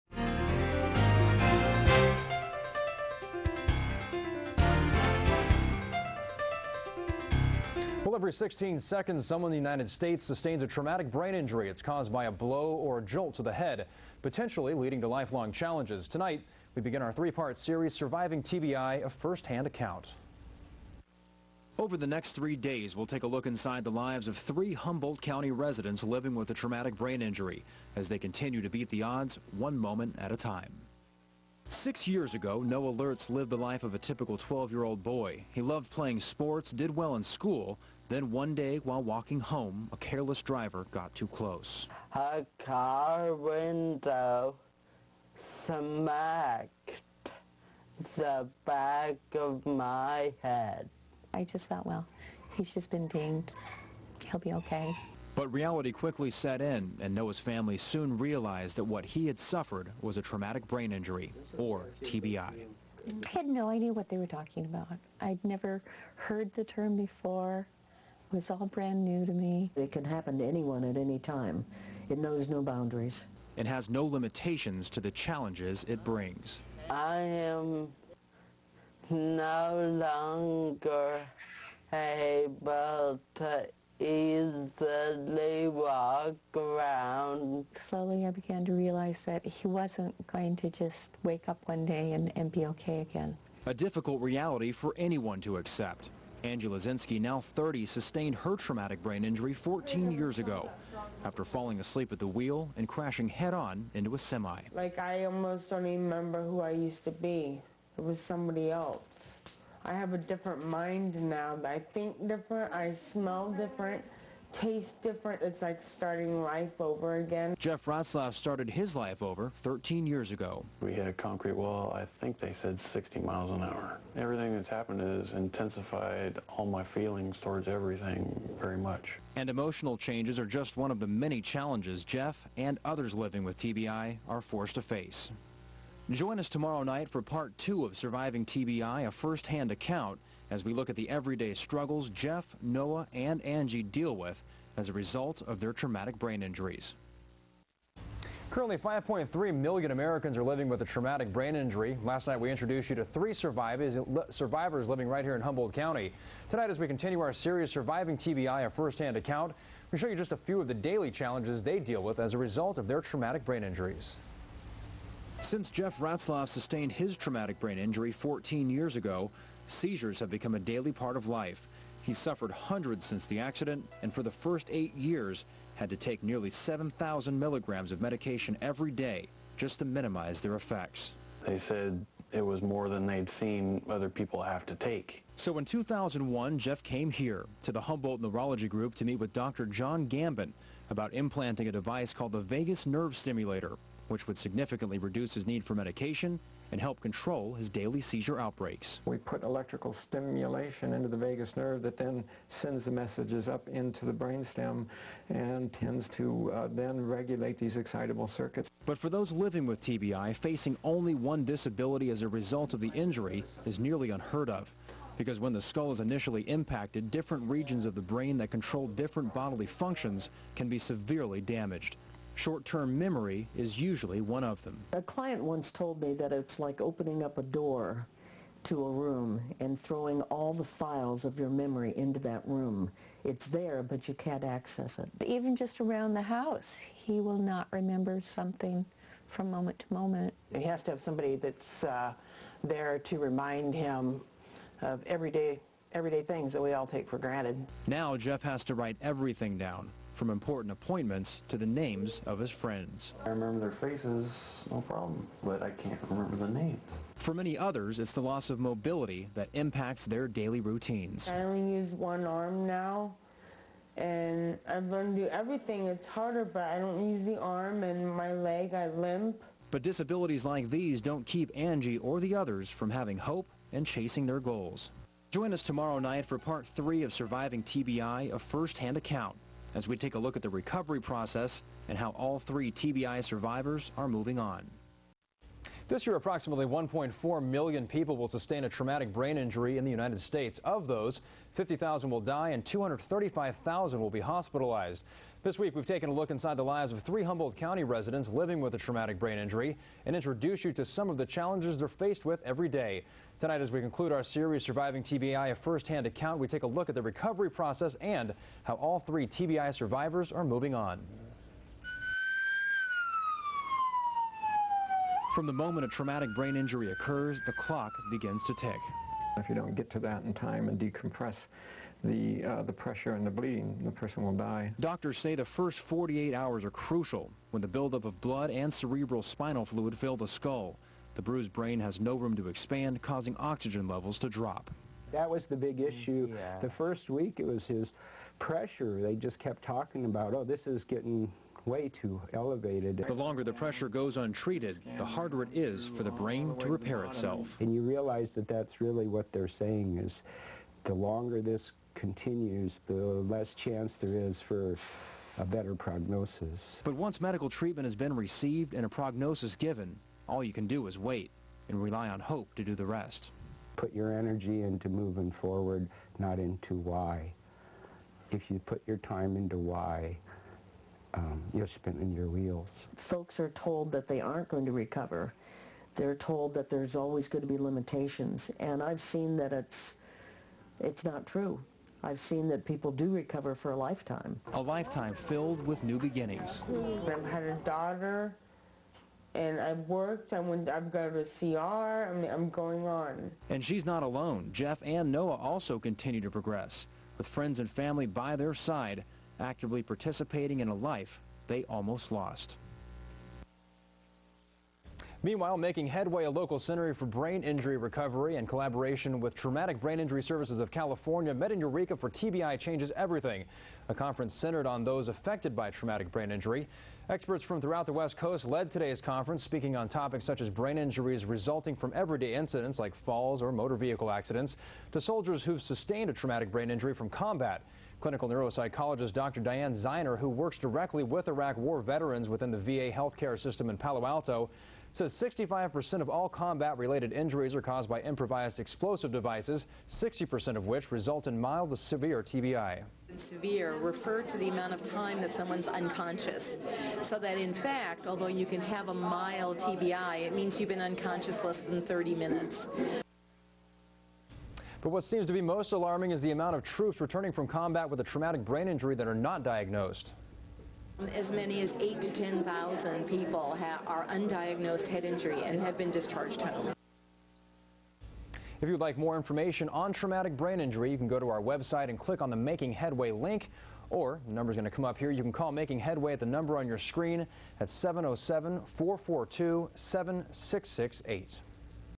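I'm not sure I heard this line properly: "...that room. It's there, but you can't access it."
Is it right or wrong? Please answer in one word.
right.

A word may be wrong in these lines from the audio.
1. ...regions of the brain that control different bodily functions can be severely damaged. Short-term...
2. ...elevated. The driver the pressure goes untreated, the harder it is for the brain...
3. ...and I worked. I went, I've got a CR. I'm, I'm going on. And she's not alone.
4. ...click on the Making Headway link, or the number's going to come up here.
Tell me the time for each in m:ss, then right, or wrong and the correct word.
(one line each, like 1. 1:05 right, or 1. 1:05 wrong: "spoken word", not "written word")
1. 3:37 right
2. 5:42 wrong: "longer", not "driver"
3. 6:29 right
4. 7:51 right.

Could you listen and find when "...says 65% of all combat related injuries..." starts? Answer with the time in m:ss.
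7:14.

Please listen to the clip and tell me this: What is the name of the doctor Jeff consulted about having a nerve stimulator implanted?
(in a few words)
Dr. John Gambin.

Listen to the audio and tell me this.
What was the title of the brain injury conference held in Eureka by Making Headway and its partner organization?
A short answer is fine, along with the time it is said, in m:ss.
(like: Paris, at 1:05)
TBI Changes Everything, at 6:52.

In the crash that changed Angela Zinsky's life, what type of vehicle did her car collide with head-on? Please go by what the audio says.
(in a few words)
A semi.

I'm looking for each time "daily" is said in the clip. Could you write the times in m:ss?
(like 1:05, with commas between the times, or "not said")
2:40, 2:50, 3:17, 4:20.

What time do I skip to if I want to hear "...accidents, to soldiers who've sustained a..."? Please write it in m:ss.
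7:04.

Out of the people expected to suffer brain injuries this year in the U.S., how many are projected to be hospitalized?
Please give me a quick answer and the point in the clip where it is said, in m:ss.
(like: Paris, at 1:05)
235,000, at 4:52.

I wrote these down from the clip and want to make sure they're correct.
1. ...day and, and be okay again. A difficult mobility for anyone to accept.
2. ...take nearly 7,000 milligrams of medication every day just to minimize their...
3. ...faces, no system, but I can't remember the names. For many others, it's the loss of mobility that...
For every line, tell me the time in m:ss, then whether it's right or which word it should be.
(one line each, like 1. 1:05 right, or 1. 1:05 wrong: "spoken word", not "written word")
1. 1:31 wrong: "reality", not "mobility"
2. 2:55 right
3. 4:13 wrong: "problem", not "system".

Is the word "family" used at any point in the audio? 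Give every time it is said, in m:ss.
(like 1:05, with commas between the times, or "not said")
0:57, 6:37.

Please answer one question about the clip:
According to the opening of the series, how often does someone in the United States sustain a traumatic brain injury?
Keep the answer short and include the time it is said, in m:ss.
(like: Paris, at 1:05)
Every 16 seconds, at 0:08.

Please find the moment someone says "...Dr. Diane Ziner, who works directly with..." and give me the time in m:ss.
7:09.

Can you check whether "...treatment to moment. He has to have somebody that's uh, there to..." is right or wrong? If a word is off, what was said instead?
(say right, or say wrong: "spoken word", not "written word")
wrong: "moment", not "treatment".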